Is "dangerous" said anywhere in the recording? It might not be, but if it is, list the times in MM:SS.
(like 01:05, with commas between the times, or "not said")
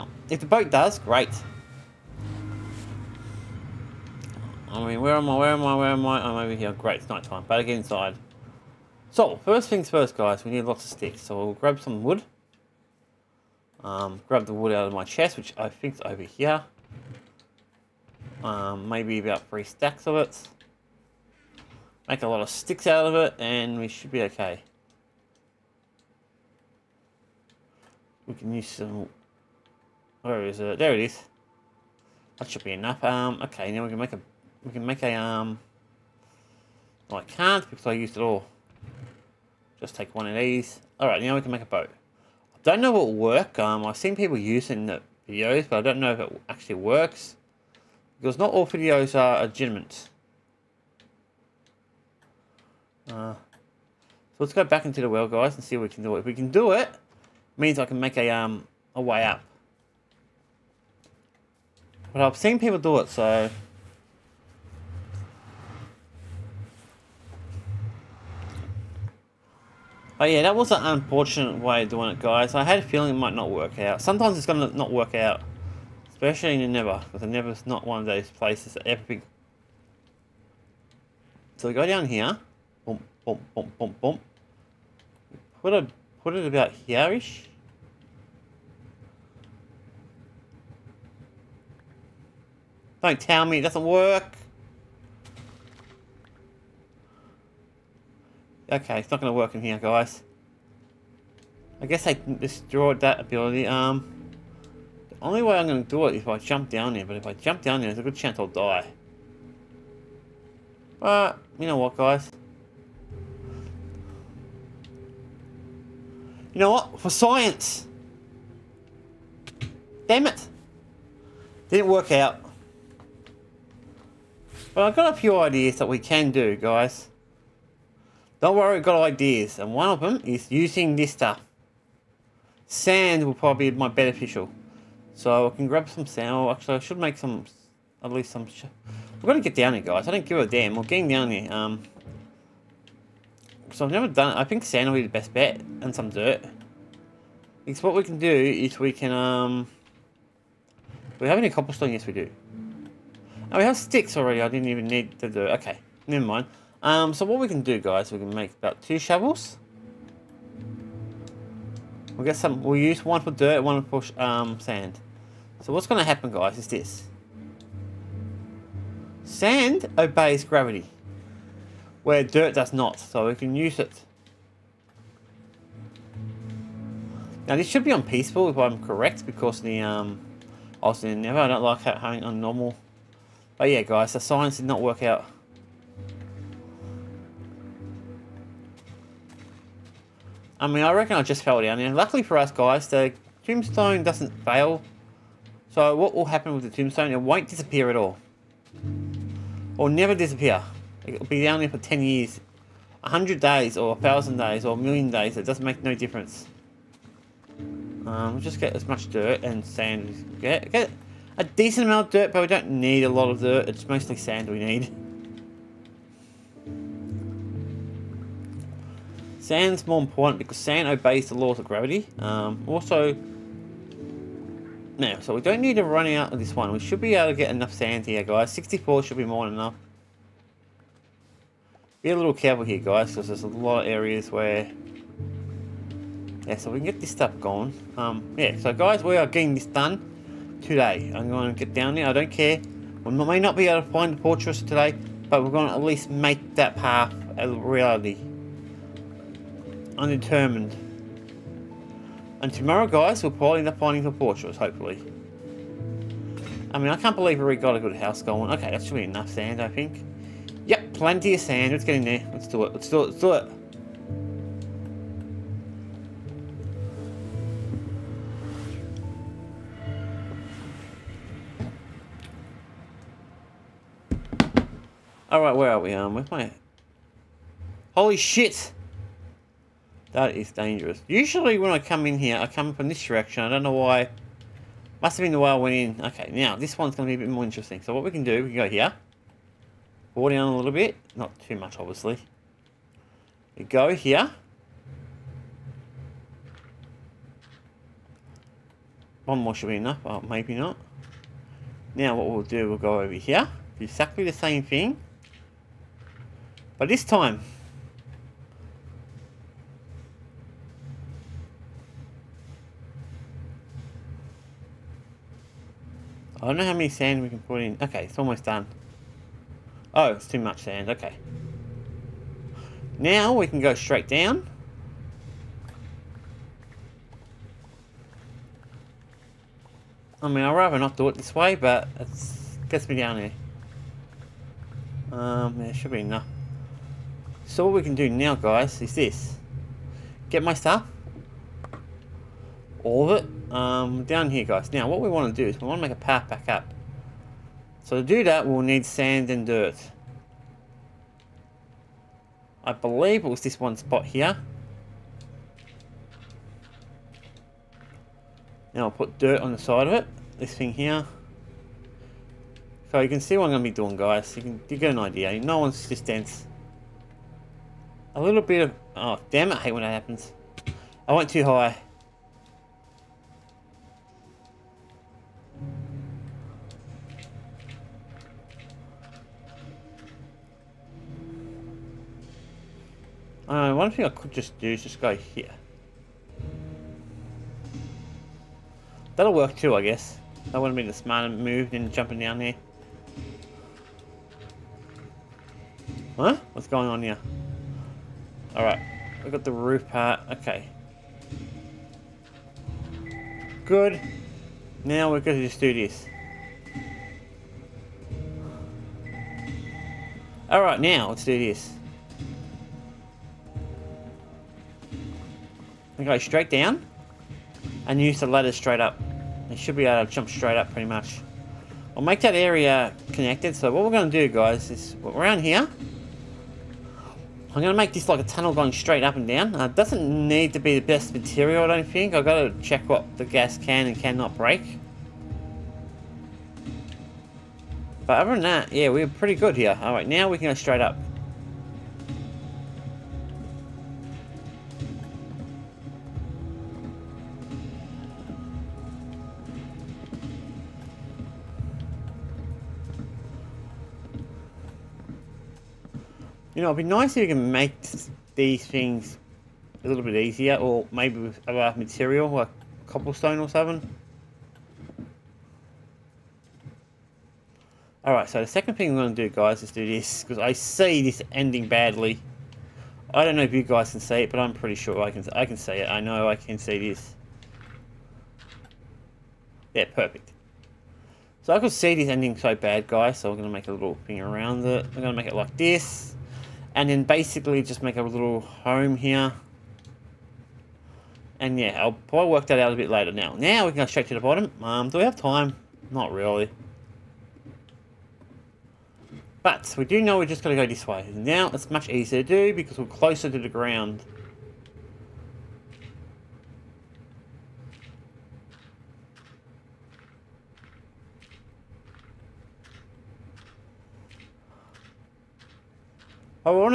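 04:40.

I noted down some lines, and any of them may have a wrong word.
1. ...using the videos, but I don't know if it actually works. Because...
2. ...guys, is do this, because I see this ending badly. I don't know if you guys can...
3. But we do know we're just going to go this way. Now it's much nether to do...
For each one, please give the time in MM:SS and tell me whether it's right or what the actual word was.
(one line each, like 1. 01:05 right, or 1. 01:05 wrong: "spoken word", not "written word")
1. 00:44 right
2. 07:49 right
3. 08:19 wrong: "easier", not "nether".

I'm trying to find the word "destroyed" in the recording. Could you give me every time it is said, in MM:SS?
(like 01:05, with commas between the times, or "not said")
01:42.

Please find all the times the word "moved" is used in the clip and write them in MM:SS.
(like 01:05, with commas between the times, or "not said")
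06:31.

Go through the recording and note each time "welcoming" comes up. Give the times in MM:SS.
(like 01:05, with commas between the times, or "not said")
not said.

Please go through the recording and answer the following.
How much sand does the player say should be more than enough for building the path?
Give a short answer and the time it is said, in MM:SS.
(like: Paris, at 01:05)
64, at 03:48.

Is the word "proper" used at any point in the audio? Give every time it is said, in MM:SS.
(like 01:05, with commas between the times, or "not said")
not said.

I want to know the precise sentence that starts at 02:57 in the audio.
Now this should be on peaceful if I'm correct, because the um, I was in nether.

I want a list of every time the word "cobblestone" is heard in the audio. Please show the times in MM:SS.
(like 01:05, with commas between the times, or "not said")
02:31, 07:42.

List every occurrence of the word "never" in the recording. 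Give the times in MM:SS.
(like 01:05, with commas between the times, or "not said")
02:23, 02:36, 03:19.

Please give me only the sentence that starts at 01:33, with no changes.
Don't tell me it doesn't work.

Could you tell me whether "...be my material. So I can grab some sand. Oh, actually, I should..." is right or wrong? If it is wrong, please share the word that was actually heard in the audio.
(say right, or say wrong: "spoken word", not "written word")
wrong: "beneficial", not "material".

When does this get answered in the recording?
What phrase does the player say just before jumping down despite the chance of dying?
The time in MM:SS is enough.
01:56.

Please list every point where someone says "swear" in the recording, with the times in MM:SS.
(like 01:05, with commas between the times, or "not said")
not said.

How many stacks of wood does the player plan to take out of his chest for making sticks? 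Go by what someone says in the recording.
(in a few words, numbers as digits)
3.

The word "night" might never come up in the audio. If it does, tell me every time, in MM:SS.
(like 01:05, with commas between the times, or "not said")
00:07.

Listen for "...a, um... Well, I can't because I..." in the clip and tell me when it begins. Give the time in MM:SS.
00:35.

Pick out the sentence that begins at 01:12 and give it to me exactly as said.
I had a feeling it might not work out.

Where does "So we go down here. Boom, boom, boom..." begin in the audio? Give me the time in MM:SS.
01:21.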